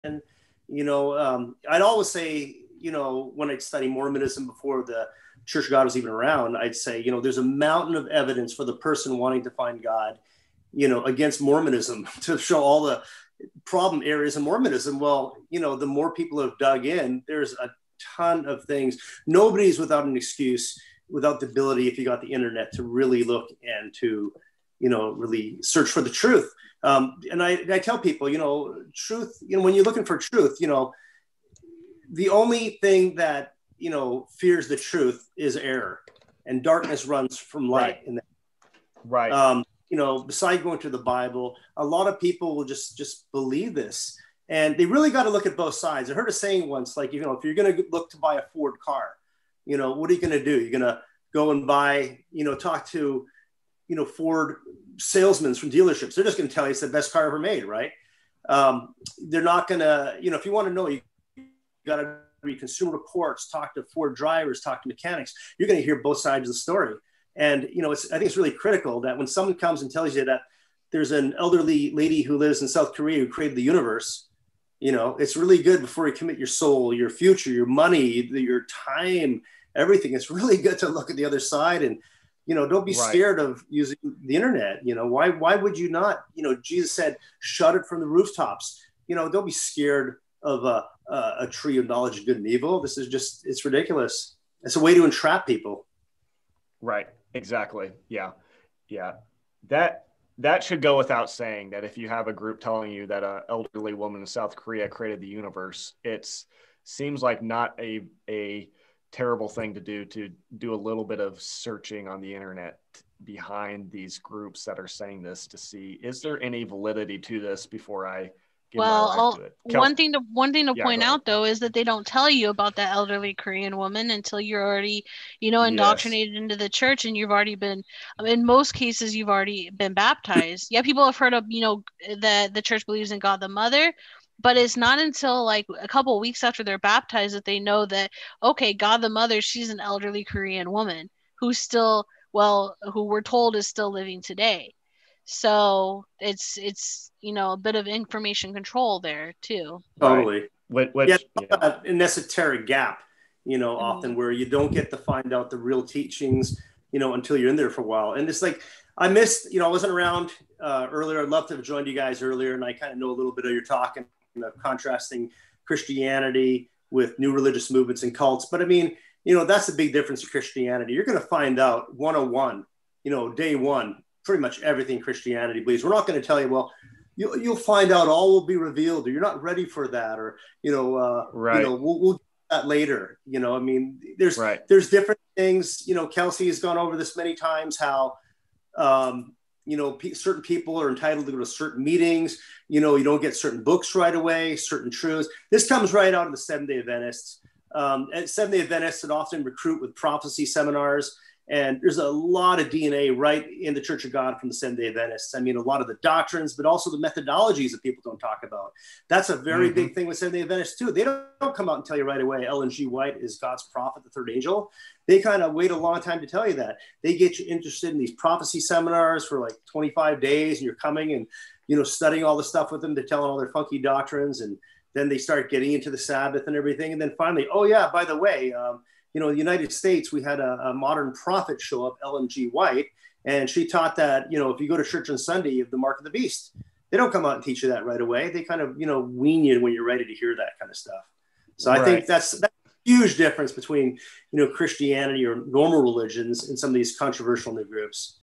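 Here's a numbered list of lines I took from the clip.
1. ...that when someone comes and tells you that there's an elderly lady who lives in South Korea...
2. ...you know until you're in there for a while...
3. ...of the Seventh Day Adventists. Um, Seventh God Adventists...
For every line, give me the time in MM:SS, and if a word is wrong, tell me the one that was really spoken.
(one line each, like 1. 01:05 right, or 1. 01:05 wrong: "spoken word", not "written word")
1. 01:09 right
2. 02:36 right
3. 03:16 wrong: "Day", not "God".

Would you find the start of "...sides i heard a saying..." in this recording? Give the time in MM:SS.
00:45.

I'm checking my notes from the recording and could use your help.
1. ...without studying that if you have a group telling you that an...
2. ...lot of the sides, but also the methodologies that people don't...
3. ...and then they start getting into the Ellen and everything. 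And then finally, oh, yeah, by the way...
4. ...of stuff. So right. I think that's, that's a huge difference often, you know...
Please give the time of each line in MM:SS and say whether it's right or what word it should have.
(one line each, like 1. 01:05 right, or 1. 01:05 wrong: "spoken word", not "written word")
1. 01:40 wrong: "saying", not "studying"
2. 03:25 wrong: "doctrines", not "sides"
3. 03:44 wrong: "Sabbath", not "Ellen"
4. 04:00 wrong: "between", not "often".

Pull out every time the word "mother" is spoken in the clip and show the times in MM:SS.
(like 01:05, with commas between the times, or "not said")
02:13, 02:19.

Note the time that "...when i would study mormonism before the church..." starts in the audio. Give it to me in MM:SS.
00:03.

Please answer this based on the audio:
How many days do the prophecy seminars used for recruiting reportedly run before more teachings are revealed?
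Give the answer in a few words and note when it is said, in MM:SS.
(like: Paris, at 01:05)
25, at 03:39.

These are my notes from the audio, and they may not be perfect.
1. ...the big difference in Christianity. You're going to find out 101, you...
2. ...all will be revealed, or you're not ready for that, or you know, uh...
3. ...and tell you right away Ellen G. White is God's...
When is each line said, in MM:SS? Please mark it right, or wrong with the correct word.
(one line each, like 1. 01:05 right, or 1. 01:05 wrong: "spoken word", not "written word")
1. 02:49 right
2. 02:58 right
3. 03:31 right.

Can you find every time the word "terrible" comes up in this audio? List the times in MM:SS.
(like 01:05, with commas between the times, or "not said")
01:49.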